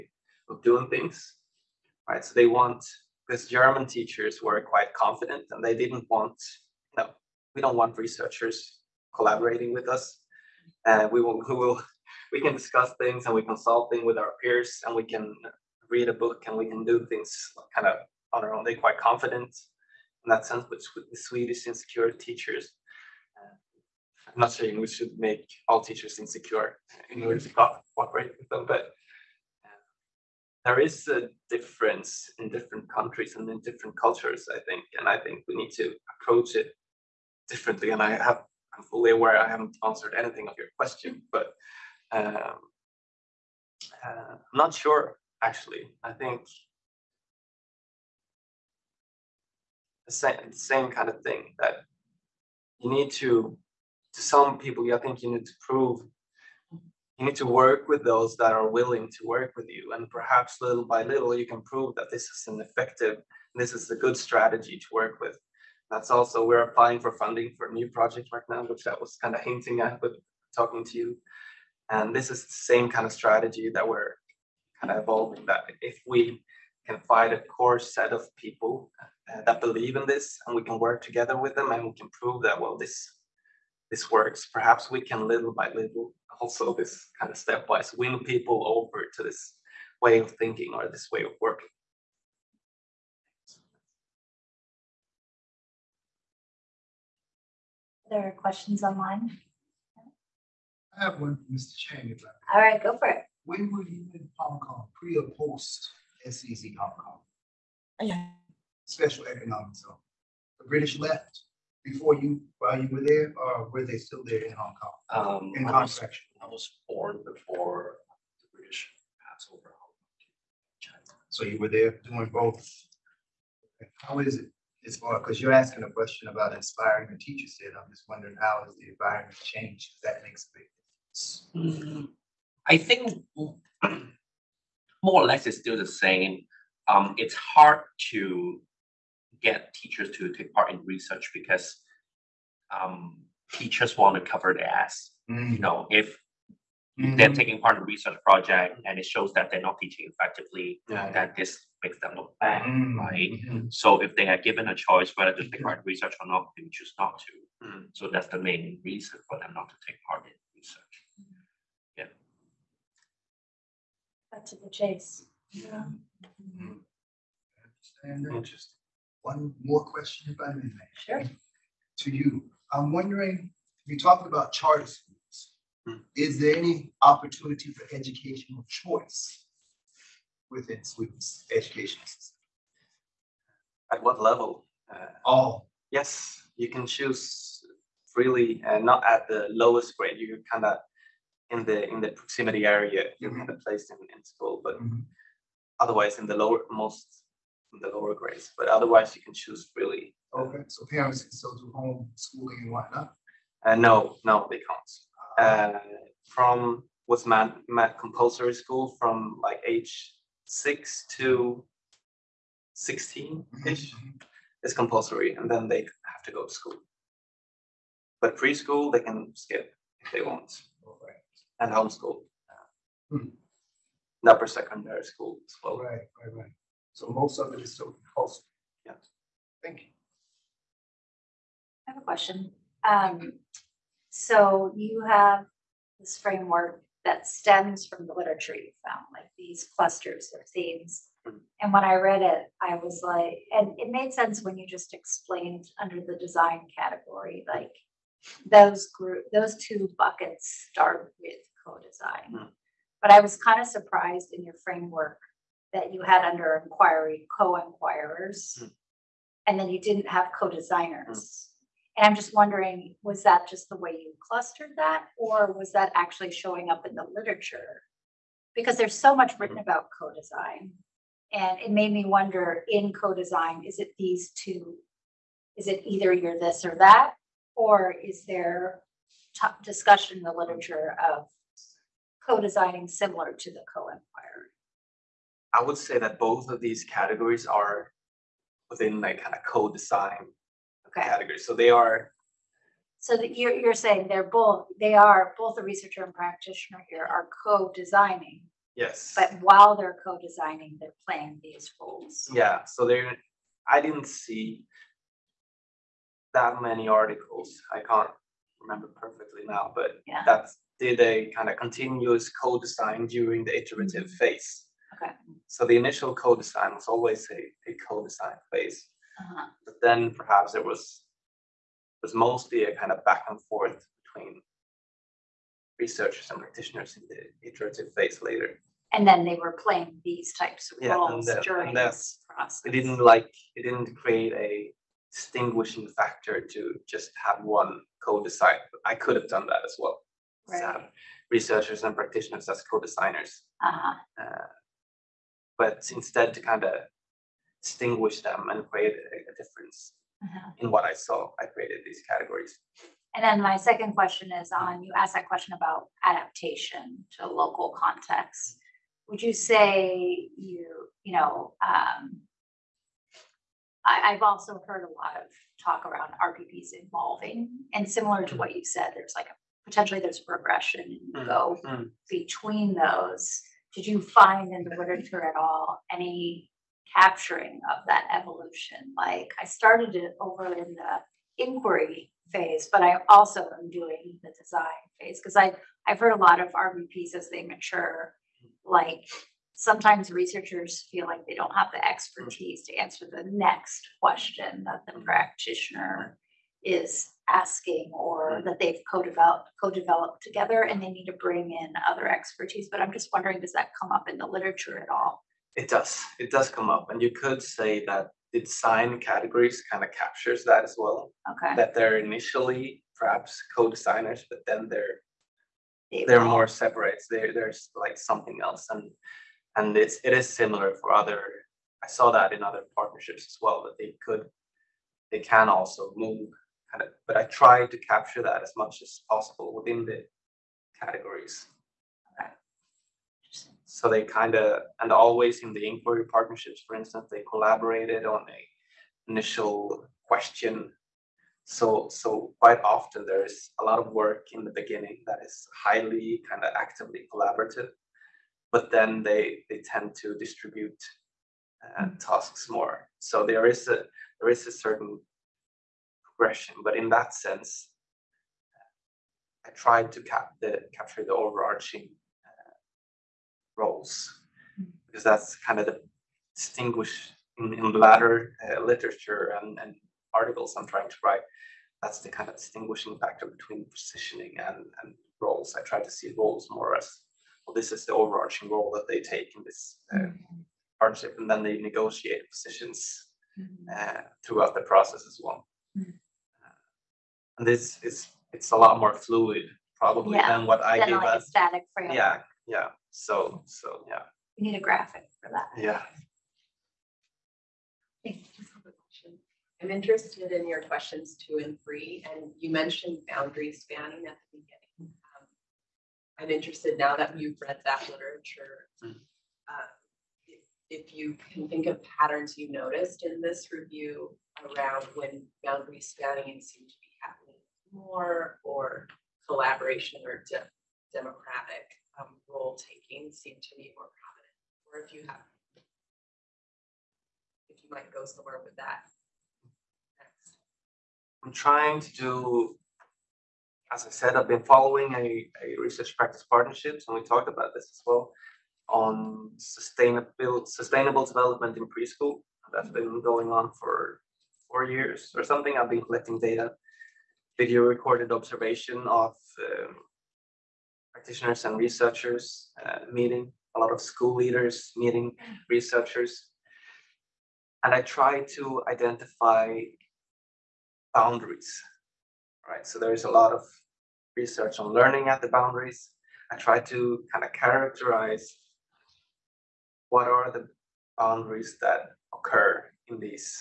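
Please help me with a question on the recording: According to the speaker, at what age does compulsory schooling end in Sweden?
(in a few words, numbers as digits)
16.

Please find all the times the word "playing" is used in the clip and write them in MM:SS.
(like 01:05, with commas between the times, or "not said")
05:01, 05:29.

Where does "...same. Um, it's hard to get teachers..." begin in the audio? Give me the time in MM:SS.
02:15.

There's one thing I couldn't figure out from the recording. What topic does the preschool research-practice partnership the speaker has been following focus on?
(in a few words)
sustainable development.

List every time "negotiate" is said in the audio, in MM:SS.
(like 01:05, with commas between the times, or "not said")
08:01.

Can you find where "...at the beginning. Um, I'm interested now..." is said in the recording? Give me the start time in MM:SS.
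08:24.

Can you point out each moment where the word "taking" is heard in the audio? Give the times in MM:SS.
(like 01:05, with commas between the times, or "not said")
02:27, 08:42.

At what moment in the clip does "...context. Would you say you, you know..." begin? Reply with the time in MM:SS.
05:57.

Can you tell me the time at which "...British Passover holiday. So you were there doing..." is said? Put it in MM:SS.
01:58.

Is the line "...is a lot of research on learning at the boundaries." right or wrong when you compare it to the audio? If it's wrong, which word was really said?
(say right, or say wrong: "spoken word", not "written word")
right.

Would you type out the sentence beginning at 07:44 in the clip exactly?
because that's kind of the distinguish in, in latter uh, literature and, and, articles I'm trying to write.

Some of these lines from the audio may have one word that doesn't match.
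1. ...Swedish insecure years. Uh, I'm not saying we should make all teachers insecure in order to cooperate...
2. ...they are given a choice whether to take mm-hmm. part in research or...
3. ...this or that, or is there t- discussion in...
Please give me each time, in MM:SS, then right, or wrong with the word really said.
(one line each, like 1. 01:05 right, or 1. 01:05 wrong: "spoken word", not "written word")
1. 00:21 wrong: "teachers", not "years"
2. 02:34 right
3. 04:36 right.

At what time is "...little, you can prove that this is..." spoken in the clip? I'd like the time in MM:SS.
01:01.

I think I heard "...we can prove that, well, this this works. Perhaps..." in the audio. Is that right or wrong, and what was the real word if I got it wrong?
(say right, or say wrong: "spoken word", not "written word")
right.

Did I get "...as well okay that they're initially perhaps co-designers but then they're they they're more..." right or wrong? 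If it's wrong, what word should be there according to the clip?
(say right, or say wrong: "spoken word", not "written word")
right.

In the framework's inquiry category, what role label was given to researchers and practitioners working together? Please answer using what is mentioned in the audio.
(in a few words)
co-inquirers.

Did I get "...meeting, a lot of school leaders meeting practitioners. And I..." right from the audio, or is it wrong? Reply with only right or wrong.
wrong.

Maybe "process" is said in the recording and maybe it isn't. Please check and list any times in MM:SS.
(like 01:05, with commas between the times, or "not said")
05:32, 08:04.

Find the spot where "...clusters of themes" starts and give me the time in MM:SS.
03:59.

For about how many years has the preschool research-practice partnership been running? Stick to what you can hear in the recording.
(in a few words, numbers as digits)
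4.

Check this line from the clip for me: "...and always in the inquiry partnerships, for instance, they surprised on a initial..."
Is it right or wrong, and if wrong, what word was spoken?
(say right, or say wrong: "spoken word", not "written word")
wrong: "collaborated", not "surprised".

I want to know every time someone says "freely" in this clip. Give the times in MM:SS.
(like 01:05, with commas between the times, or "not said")
03:08, 03:19.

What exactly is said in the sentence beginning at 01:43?
When were you in Hong Kong, pre or post SEZ Hong Kong?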